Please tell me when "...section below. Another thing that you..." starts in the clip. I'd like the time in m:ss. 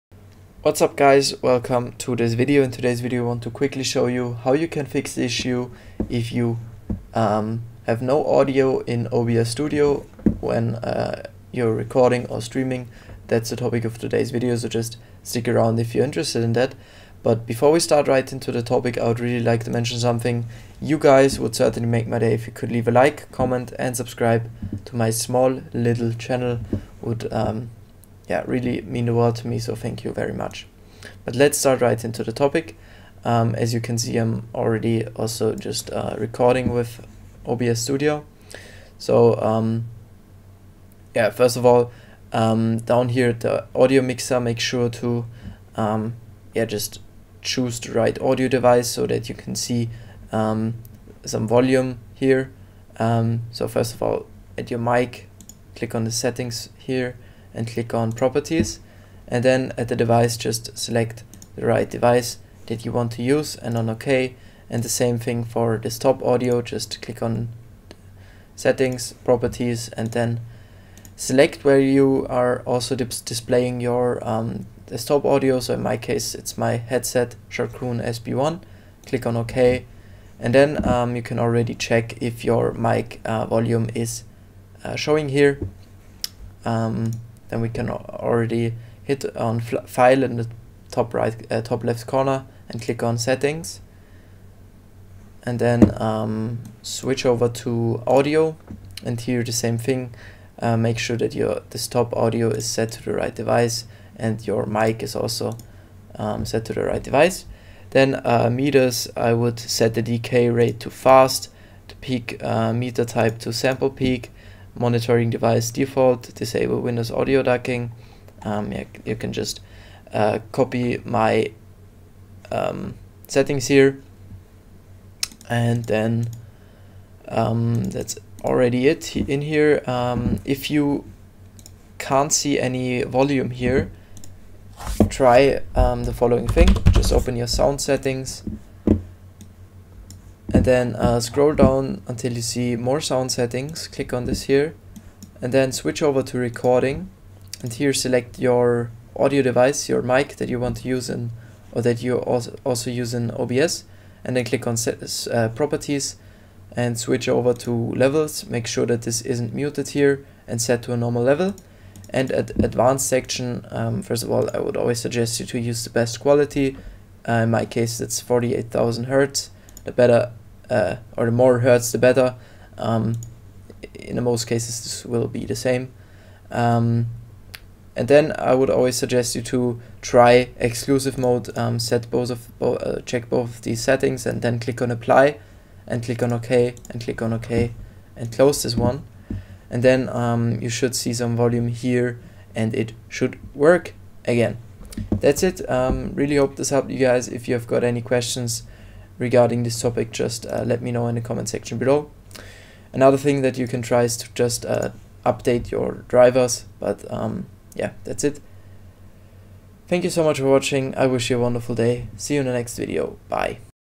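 3:21.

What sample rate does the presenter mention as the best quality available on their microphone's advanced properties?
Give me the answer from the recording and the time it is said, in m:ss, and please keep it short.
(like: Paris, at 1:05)
48,000 Hertz, at 2:48.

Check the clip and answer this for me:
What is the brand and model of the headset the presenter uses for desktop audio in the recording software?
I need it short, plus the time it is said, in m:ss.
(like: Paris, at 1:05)
Sharkoon SB1, at 1:17.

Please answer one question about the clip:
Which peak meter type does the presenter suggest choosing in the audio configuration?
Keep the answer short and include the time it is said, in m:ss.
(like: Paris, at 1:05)
sample peak, at 1:53.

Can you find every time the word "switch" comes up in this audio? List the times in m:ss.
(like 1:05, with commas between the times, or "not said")
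1:36, 2:25, 2:36.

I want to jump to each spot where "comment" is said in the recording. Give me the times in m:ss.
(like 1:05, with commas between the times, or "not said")
0:23, 3:21.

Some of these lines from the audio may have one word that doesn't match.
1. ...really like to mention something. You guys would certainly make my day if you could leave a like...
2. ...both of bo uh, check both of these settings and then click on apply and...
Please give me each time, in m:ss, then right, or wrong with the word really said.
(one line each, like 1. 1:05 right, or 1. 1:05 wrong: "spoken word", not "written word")
1. 0:19 right
2. 3:02 right.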